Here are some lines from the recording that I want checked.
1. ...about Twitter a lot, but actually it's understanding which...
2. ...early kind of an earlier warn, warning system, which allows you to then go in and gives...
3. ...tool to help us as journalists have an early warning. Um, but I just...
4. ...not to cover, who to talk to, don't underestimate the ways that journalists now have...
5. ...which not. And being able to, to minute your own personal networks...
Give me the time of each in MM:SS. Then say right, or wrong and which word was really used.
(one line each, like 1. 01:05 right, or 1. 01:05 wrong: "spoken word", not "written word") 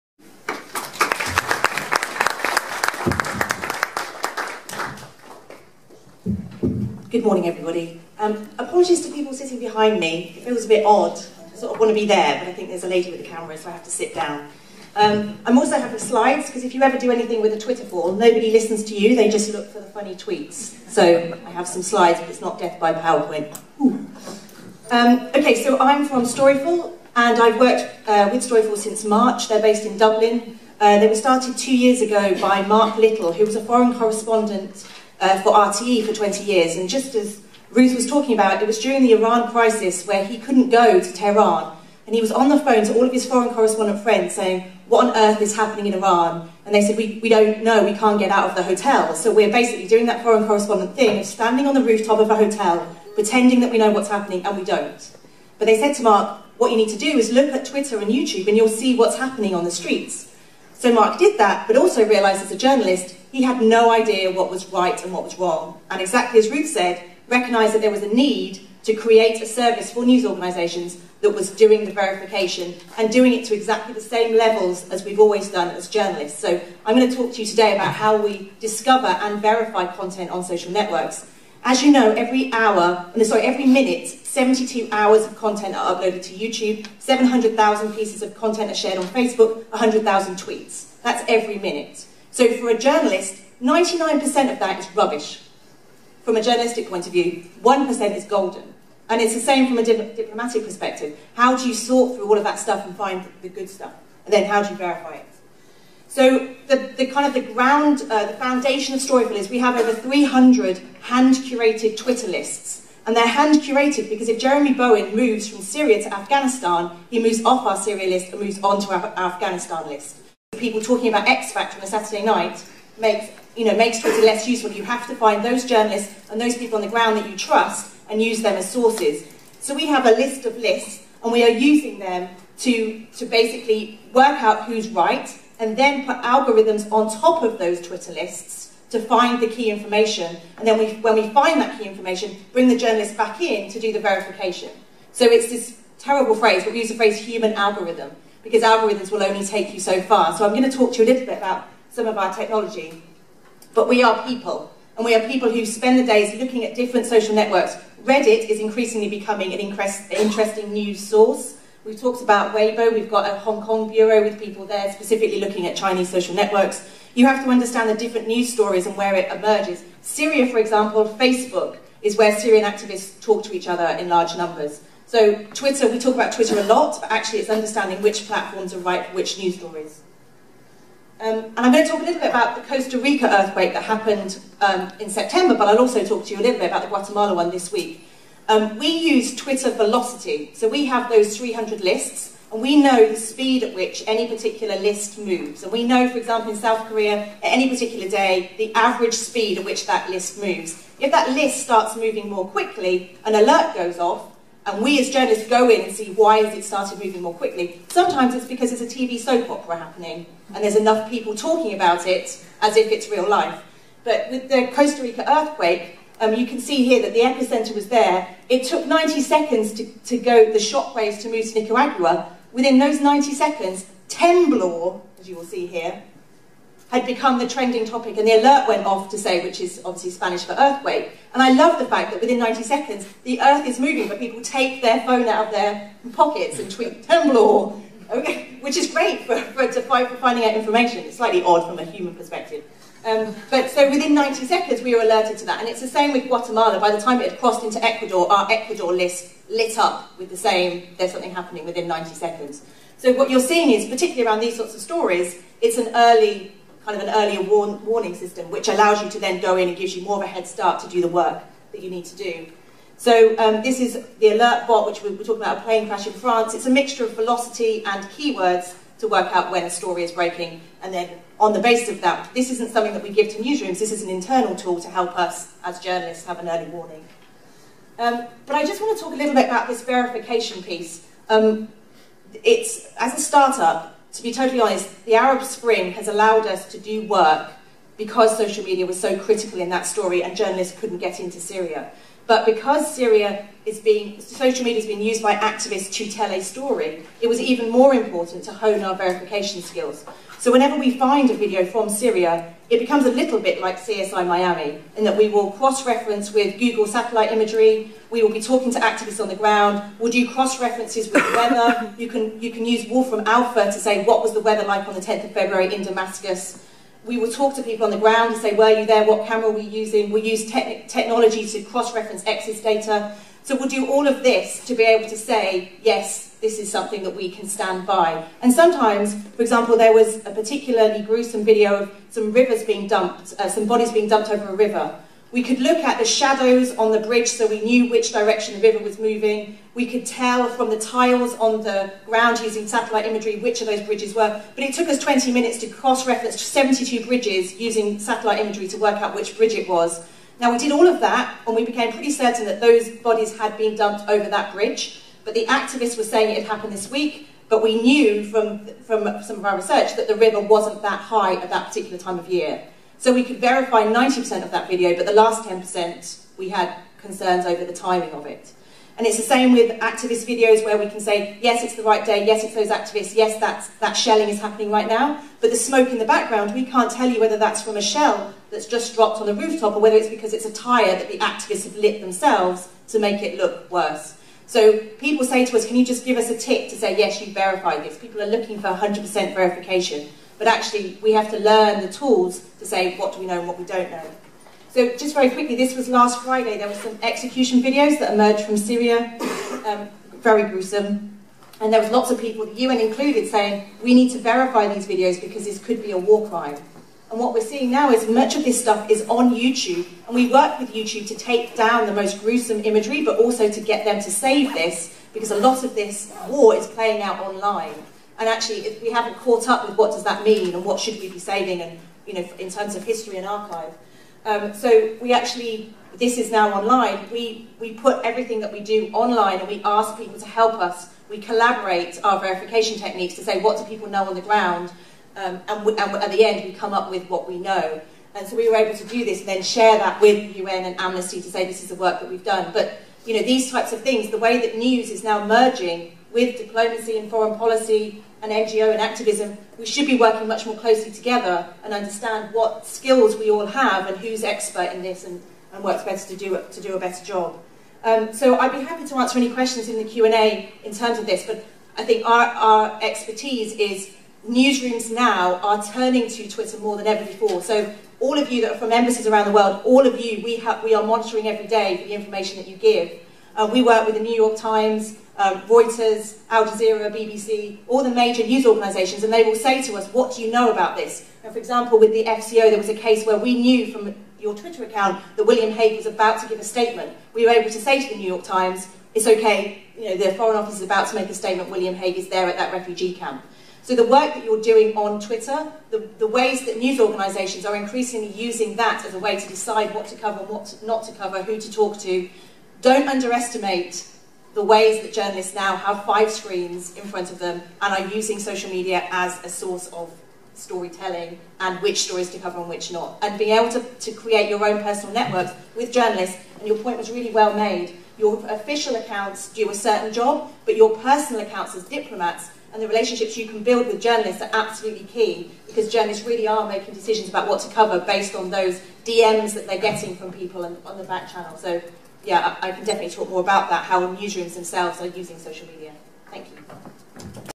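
1. 02:56 right
2. 04:15 right
3. 04:34 right
4. 08:20 right
5. 08:32 wrong: "create", not "minute".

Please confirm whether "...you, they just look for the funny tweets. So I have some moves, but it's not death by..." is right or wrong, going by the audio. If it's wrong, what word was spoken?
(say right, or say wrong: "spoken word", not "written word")
wrong: "slides", not "moves".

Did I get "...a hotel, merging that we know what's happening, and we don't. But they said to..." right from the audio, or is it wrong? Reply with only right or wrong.
wrong.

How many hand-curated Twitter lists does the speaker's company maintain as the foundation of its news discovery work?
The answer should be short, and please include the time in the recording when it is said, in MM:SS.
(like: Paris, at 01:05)
Over 300, at 01:49.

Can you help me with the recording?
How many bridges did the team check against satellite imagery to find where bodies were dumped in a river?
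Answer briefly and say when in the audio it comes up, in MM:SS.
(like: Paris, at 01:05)
72, at 05:46.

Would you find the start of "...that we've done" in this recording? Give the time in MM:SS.
07:22.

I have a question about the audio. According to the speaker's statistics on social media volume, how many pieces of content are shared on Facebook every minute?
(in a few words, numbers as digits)
700,000.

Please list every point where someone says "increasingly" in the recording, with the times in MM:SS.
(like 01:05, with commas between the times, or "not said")
02:38, 08:17.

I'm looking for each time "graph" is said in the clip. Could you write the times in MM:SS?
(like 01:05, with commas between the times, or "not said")
not said.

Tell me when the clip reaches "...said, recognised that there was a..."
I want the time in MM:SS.
01:06.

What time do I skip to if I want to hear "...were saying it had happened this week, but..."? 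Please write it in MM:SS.
05:55.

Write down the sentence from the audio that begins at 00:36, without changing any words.
And just as Ruth was talking about, it was during the Iran crisis where he couldn't go to Tehran.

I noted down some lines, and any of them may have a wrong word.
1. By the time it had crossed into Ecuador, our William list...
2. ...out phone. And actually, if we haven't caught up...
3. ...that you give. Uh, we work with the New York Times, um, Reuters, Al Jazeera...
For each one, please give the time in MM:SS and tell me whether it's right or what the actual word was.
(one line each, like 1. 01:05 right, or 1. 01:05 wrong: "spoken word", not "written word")
1. 04:06 wrong: "Ecuador", not "William"
2. 06:57 wrong: "online", not "phone"
3. 07:52 right.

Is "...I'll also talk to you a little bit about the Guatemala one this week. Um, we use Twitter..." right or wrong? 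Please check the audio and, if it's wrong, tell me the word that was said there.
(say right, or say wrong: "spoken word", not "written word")
right.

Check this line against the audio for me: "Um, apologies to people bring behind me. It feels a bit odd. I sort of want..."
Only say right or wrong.
wrong.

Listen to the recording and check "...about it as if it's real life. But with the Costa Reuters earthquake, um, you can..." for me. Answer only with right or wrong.
wrong.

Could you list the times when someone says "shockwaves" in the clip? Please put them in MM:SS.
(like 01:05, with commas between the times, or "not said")
03:40.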